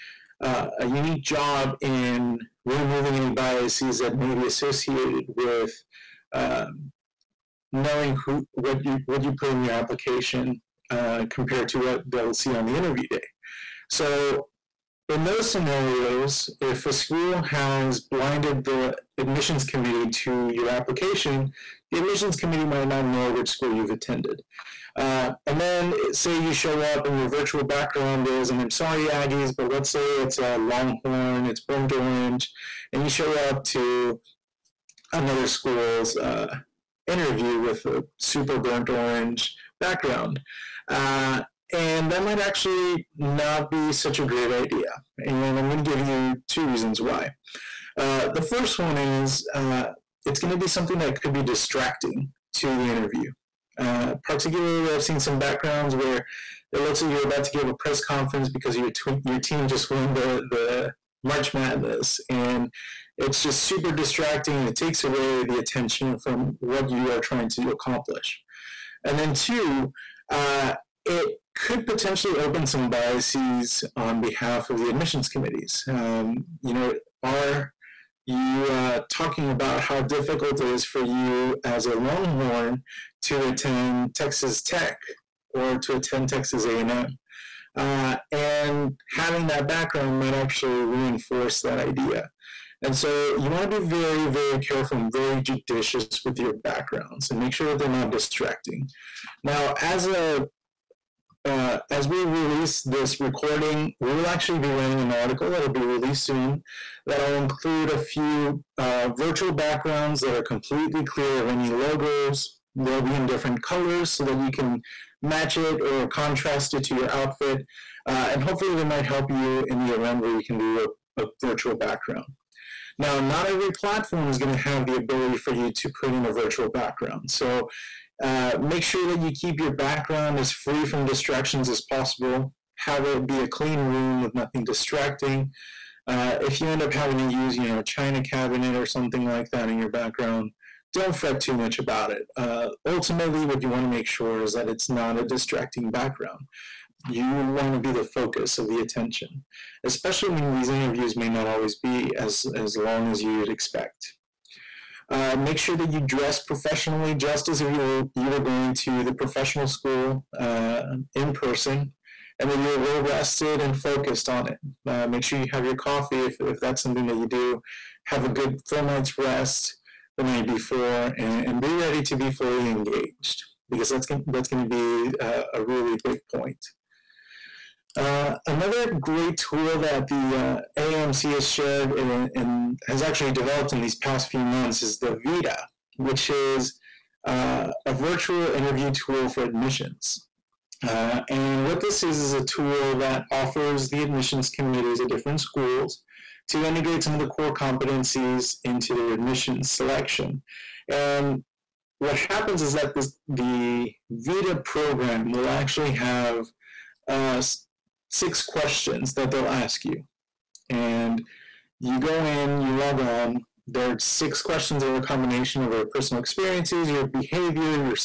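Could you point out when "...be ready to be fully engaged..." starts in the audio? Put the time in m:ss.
2:51.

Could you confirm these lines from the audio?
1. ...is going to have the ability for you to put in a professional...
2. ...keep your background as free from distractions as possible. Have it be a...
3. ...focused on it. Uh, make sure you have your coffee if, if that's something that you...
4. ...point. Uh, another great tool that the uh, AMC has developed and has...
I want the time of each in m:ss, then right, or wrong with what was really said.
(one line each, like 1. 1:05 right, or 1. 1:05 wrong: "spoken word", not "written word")
1. 2:04 wrong: "virtual", not "professional"
2. 2:09 right
3. 2:43 right
4. 2:56 wrong: "shared", not "developed".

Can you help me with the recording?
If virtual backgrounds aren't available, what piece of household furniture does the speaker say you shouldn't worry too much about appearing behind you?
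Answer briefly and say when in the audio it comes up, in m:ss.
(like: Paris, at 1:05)
china cabinet, at 2:17.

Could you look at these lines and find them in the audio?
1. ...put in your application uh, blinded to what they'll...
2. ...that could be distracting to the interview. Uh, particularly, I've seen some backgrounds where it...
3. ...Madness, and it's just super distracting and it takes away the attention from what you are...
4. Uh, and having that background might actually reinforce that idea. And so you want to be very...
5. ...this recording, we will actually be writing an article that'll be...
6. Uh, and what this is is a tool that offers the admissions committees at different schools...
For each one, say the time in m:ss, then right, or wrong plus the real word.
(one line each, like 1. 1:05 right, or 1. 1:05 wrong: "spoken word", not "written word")
1. 0:09 wrong: "compared", not "blinded"
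2. 0:50 right
3. 1:01 right
4. 1:27 right
5. 1:42 right
6. 3:10 right.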